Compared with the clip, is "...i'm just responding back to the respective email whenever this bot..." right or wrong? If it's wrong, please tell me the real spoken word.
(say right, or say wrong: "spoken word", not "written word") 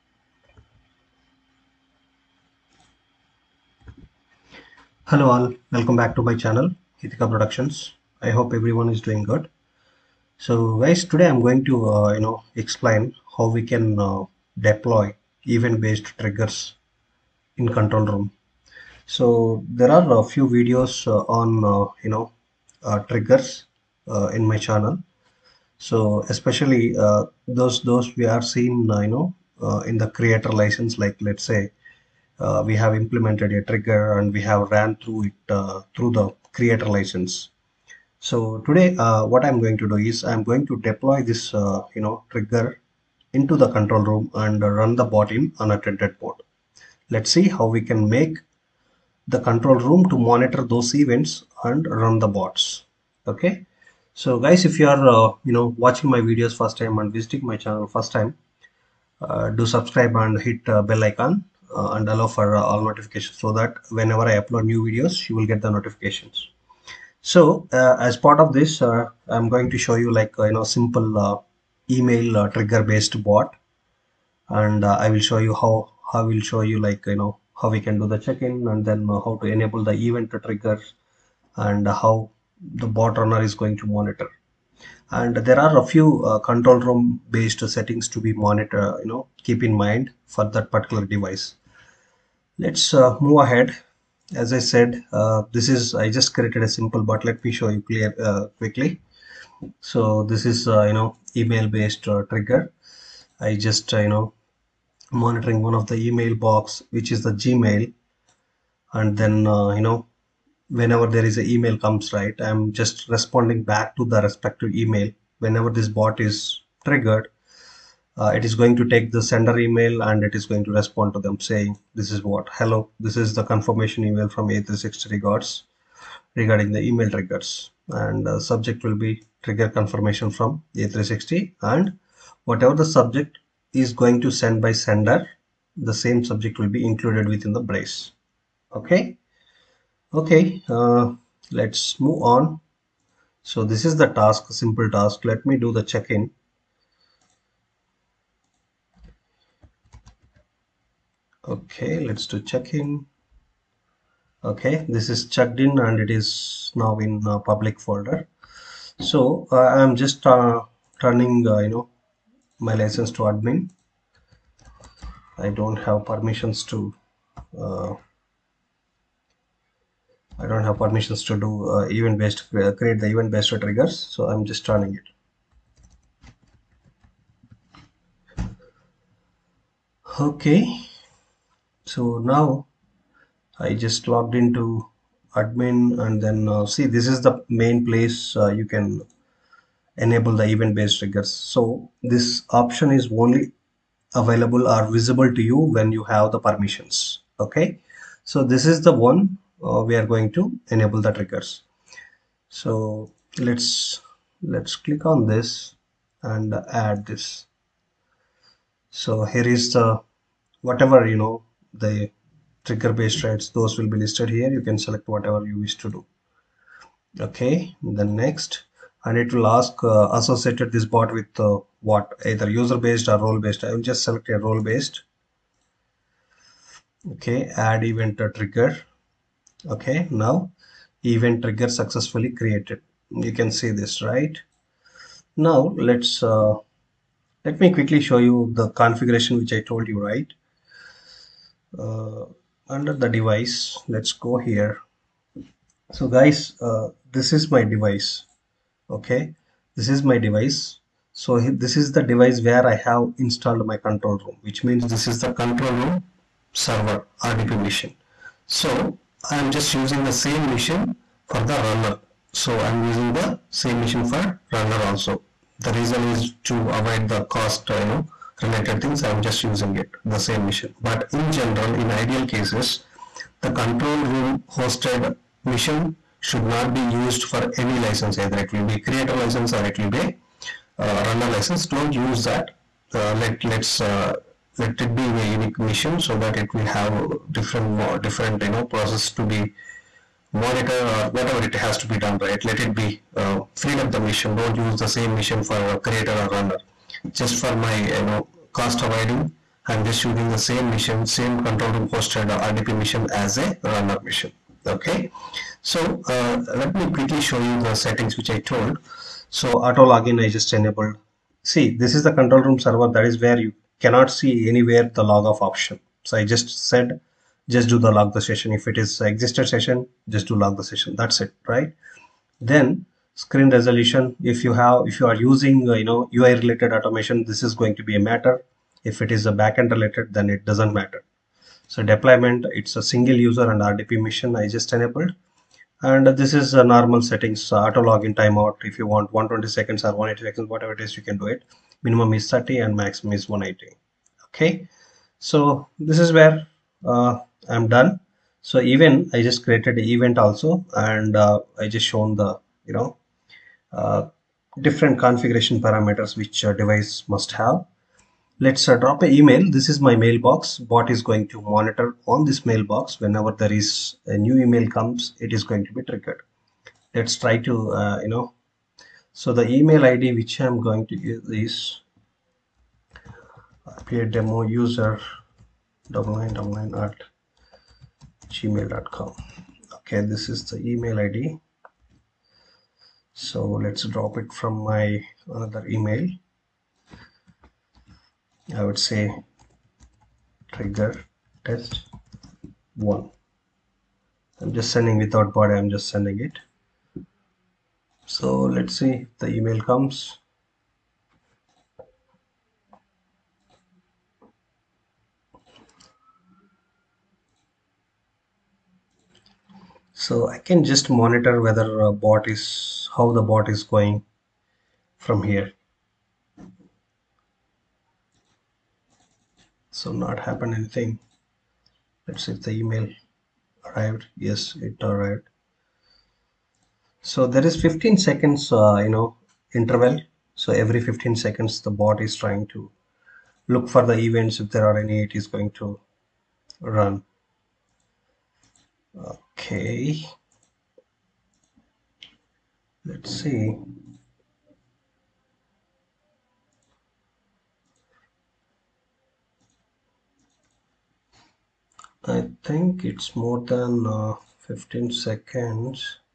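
right.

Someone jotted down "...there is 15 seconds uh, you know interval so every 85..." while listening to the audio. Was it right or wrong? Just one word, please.
wrong.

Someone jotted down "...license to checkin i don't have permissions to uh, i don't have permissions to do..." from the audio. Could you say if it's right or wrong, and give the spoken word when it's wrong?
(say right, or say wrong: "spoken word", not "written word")
wrong: "admin", not "checkin".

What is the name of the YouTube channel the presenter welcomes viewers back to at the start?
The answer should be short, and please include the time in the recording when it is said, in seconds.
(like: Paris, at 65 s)
Hithika Productions, at 6 s.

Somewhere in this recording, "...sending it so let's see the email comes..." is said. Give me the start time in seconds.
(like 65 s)
395 s.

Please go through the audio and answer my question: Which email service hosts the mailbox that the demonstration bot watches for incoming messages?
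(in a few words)
Gmail.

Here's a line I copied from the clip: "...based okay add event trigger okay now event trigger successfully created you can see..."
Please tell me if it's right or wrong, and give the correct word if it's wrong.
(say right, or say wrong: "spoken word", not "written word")
right.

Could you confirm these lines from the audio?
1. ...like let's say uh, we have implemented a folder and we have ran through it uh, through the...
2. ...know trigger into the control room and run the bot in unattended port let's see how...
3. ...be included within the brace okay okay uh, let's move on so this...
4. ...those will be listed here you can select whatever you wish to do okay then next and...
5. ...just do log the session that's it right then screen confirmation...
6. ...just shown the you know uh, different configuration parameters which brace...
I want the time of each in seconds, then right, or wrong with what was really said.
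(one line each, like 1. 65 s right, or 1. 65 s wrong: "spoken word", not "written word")
1. 30 s wrong: "trigger", not "folder"
2. 42 s right
3. 136 s right
4. 213 s right
5. 320 s wrong: "resolution", not "confirmation"
6. 351 s wrong: "device", not "brace".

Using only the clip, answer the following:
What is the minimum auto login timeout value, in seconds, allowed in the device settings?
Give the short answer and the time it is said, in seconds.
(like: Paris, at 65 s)
30, at 342 s.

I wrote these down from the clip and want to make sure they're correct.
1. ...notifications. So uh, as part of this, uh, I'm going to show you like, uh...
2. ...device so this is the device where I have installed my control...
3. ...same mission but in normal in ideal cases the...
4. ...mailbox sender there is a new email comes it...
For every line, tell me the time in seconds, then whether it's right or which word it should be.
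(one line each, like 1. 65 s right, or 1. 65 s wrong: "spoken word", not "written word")
1. 65 s right
2. 250 s right
3. 270 s wrong: "general", not "normal"
4. 362 s wrong: "whenever", not "sender".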